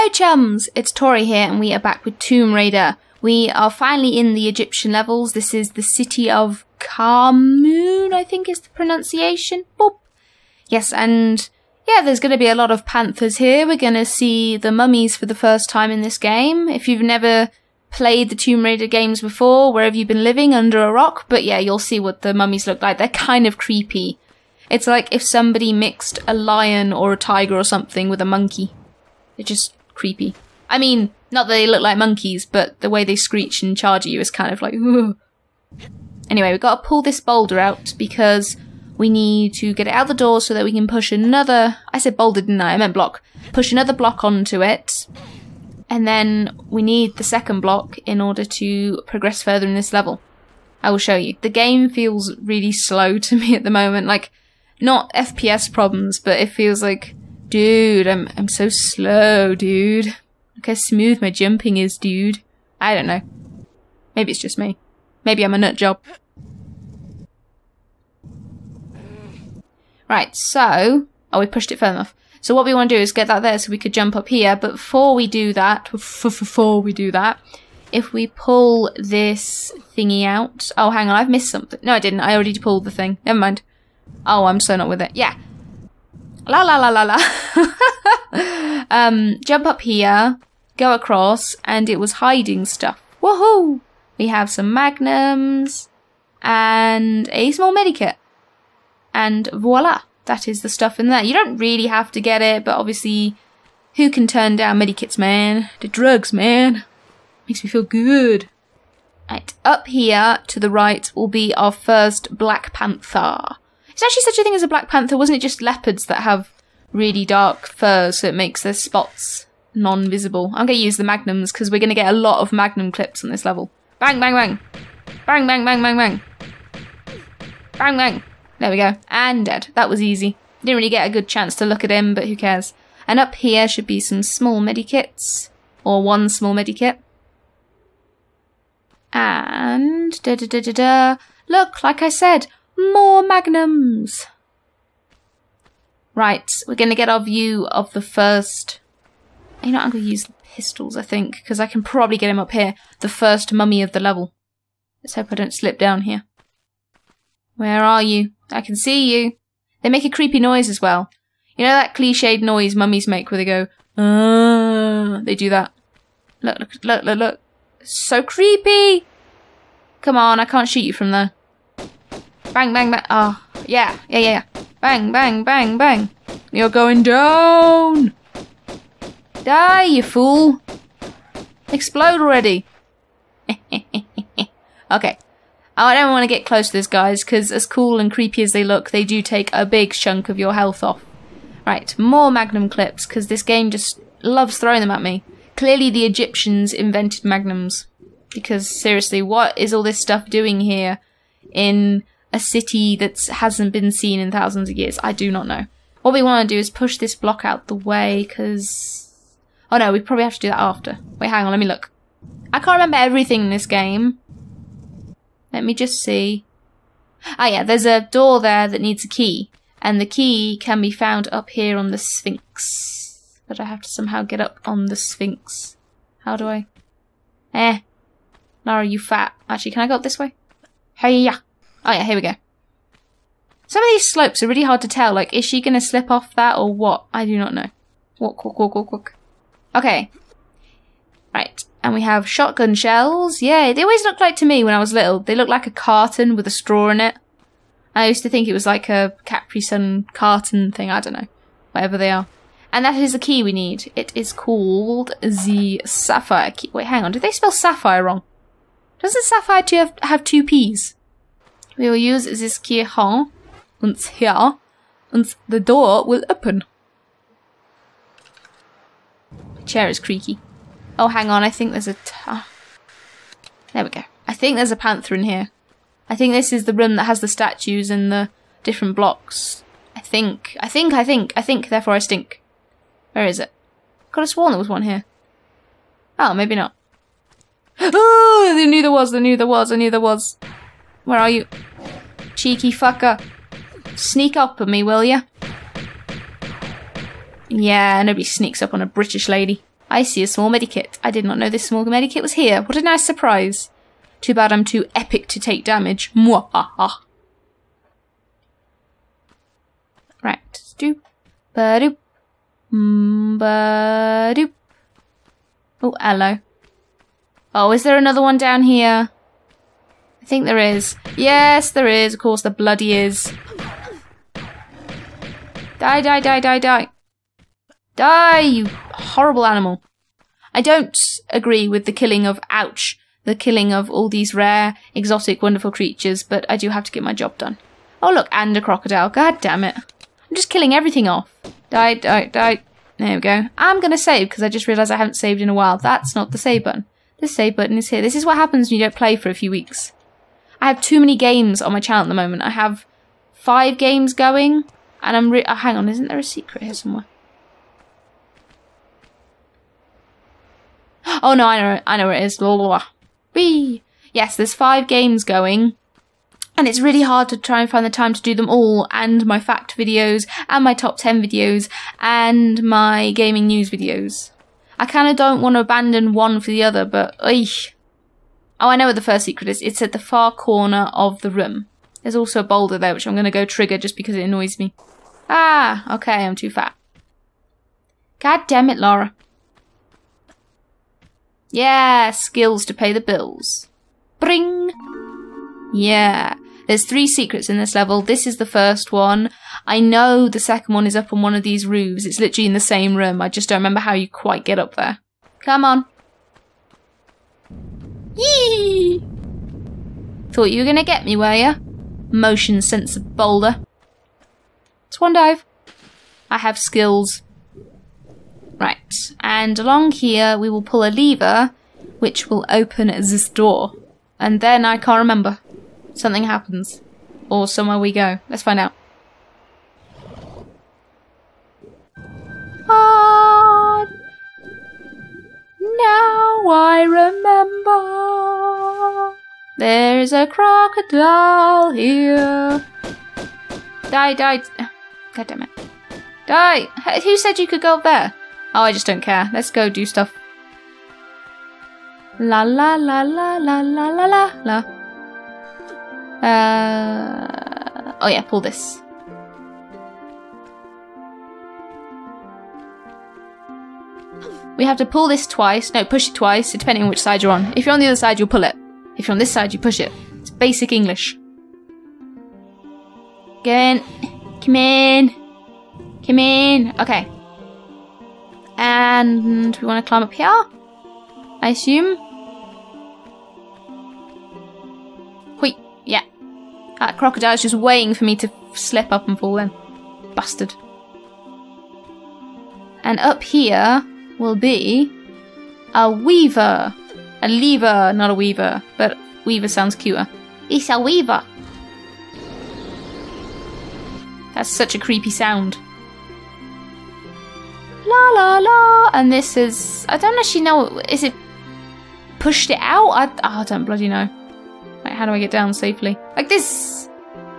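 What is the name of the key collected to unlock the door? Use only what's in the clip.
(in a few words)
sapphire key.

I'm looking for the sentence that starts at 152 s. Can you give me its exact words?
The first mummy of the level.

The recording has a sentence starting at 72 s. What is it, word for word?
So what we want to do is get that there so we could jump up here.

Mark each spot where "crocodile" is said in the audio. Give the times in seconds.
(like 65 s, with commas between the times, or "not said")
338 s, 440 s, 486 s.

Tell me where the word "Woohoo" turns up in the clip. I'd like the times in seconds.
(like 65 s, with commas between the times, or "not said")
93 s.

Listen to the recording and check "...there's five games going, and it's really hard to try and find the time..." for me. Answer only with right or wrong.
right.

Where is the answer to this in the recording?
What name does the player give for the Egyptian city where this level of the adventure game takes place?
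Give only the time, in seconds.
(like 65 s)
6 s.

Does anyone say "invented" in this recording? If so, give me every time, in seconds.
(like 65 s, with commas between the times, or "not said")
196 s.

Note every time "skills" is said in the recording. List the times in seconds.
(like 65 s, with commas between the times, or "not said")
392 s, 416 s.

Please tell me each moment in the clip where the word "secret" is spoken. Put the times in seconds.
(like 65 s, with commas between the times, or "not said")
356 s, 379 s, 397 s.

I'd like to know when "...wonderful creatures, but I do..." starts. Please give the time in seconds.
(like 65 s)
335 s.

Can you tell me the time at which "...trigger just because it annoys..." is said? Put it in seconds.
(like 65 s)
383 s.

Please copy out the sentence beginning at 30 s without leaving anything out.
I mean, not that they look like monkeys, but the way they screech and charge you is kind of like.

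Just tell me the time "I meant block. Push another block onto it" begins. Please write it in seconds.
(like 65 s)
42 s.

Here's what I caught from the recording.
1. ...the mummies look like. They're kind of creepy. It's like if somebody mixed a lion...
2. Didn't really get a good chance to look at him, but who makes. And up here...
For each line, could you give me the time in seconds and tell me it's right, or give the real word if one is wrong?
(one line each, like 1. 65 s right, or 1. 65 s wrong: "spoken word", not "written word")
1. 22 s right
2. 130 s wrong: "cares", not "makes".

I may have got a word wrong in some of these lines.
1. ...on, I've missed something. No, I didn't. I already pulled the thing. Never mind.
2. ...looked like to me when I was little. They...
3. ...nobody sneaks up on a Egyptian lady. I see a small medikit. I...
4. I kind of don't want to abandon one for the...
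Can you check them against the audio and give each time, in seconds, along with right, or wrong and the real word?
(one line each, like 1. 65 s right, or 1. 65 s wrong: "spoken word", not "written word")
1. 81 s right
2. 244 s right
3. 298 s wrong: "British", not "Egyptian"
4. 374 s right.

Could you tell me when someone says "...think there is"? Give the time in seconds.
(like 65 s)
320 s.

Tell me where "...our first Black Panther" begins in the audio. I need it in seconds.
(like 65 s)
111 s.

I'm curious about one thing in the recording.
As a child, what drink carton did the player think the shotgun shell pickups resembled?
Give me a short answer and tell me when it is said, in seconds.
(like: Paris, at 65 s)
Capri Sun, at 249 s.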